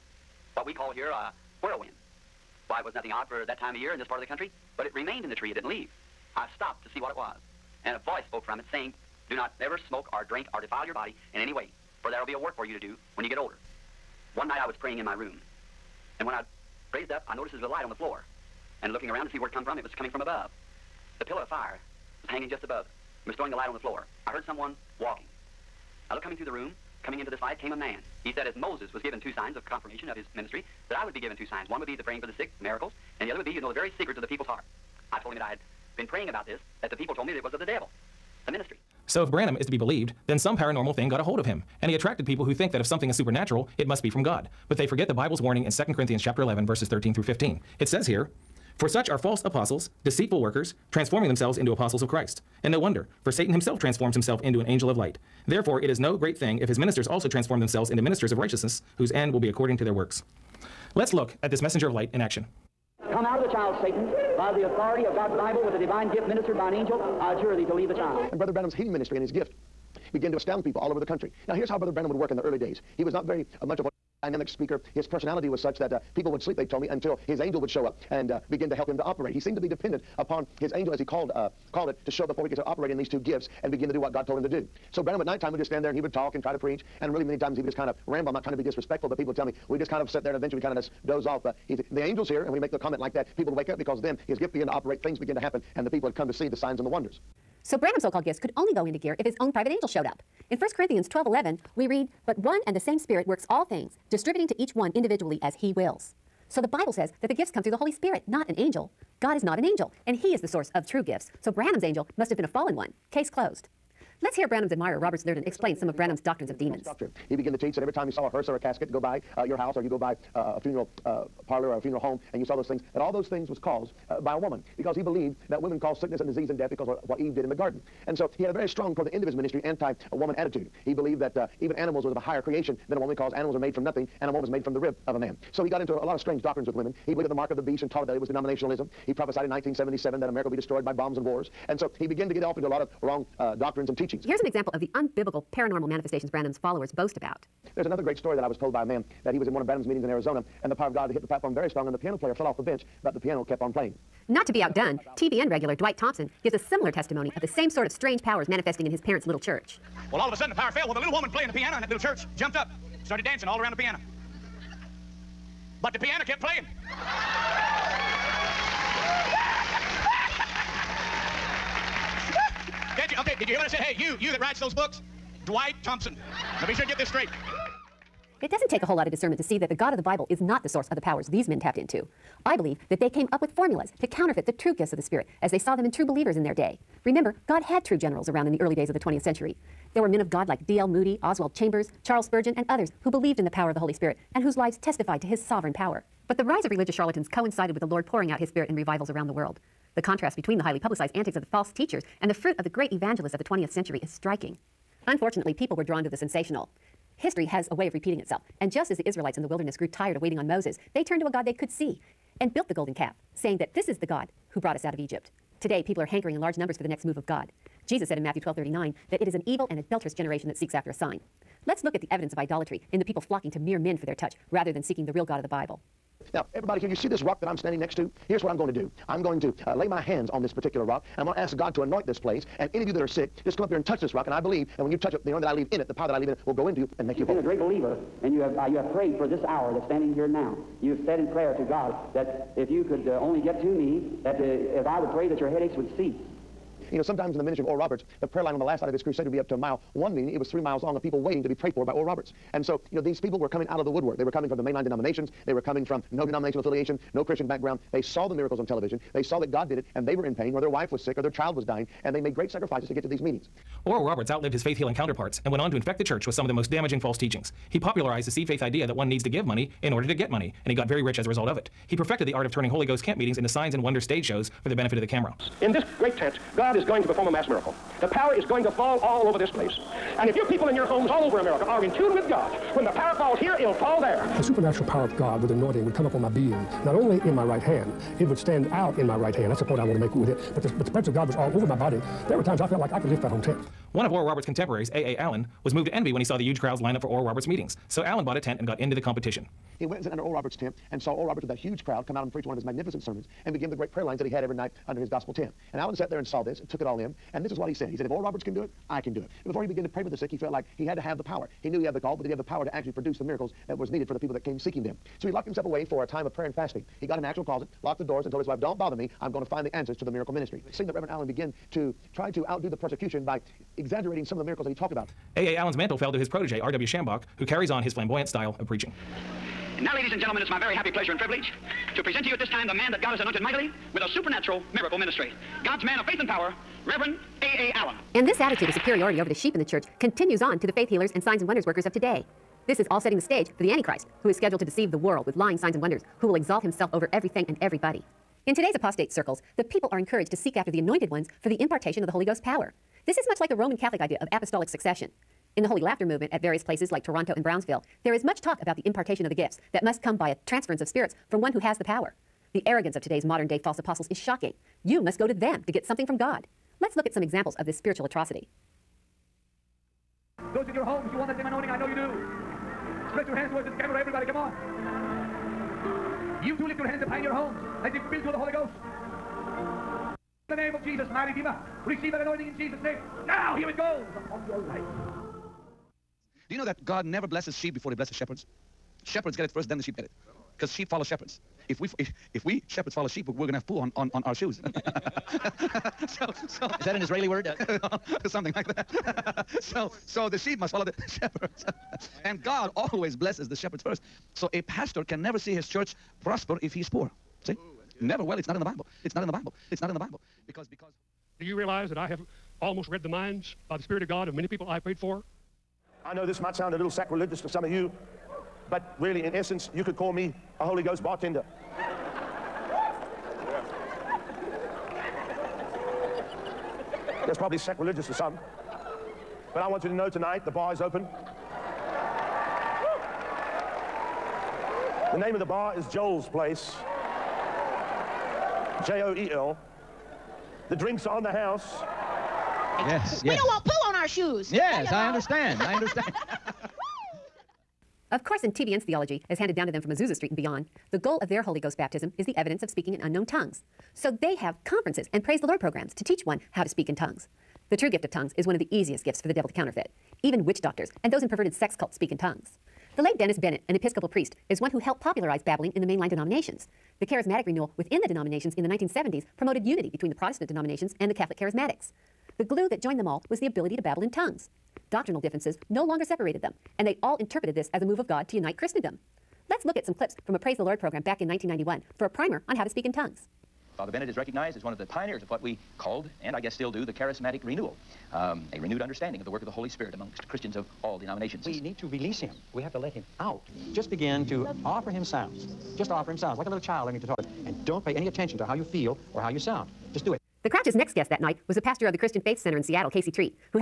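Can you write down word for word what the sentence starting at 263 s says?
Oral Roberts outlived his faith healing counterparts and went on to infect the church with some of the most damaging false teachings.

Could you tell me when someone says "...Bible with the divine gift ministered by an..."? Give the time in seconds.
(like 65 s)
65 s.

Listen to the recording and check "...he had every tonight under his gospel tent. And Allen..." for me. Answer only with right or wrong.
wrong.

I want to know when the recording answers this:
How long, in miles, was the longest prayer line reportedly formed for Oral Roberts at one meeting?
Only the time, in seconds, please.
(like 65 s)
250 s.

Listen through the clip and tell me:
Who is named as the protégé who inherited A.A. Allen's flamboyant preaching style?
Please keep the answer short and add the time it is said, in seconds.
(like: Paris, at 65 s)
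R.W. Schambach, at 326 s.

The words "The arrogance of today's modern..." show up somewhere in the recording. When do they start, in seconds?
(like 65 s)
362 s.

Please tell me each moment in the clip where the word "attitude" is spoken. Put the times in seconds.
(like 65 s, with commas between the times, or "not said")
130 s, 338 s.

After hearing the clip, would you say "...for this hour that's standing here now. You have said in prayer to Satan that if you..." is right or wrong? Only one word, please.
wrong.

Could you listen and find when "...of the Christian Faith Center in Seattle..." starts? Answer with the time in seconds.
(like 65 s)
501 s.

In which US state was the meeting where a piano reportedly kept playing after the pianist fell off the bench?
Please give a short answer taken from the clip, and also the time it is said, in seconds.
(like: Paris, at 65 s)
Arizona, at 150 s.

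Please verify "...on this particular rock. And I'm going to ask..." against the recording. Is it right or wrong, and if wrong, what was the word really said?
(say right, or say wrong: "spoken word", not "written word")
right.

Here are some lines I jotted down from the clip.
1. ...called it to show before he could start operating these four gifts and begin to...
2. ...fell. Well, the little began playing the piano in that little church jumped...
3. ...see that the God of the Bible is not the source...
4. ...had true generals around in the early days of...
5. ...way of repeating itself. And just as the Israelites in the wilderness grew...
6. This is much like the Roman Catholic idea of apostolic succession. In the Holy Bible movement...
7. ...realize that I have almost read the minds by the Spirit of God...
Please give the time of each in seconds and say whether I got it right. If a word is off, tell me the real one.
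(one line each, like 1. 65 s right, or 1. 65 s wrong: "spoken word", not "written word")
1. 81 s wrong: "two", not "four"
2. 160 s wrong: "woman", not "began"
3. 179 s right
4. 187 s right
5. 207 s right
6. 353 s wrong: "Laughter", not "Bible"
7. 411 s right.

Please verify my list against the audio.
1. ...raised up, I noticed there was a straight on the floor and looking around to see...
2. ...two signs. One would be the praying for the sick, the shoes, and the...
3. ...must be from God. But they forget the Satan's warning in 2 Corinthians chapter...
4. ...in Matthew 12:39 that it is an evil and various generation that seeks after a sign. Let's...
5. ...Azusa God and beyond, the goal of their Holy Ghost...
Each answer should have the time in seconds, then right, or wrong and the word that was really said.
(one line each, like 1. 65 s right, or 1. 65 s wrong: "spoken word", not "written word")
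1. 16 s wrong: "light", not "straight"
2. 31 s wrong: "miracles", not "shoes"
3. 43 s wrong: "Bible", not "Satan"
4. 218 s wrong: "adulterous", not "various"
5. 449 s wrong: "Street", not "God".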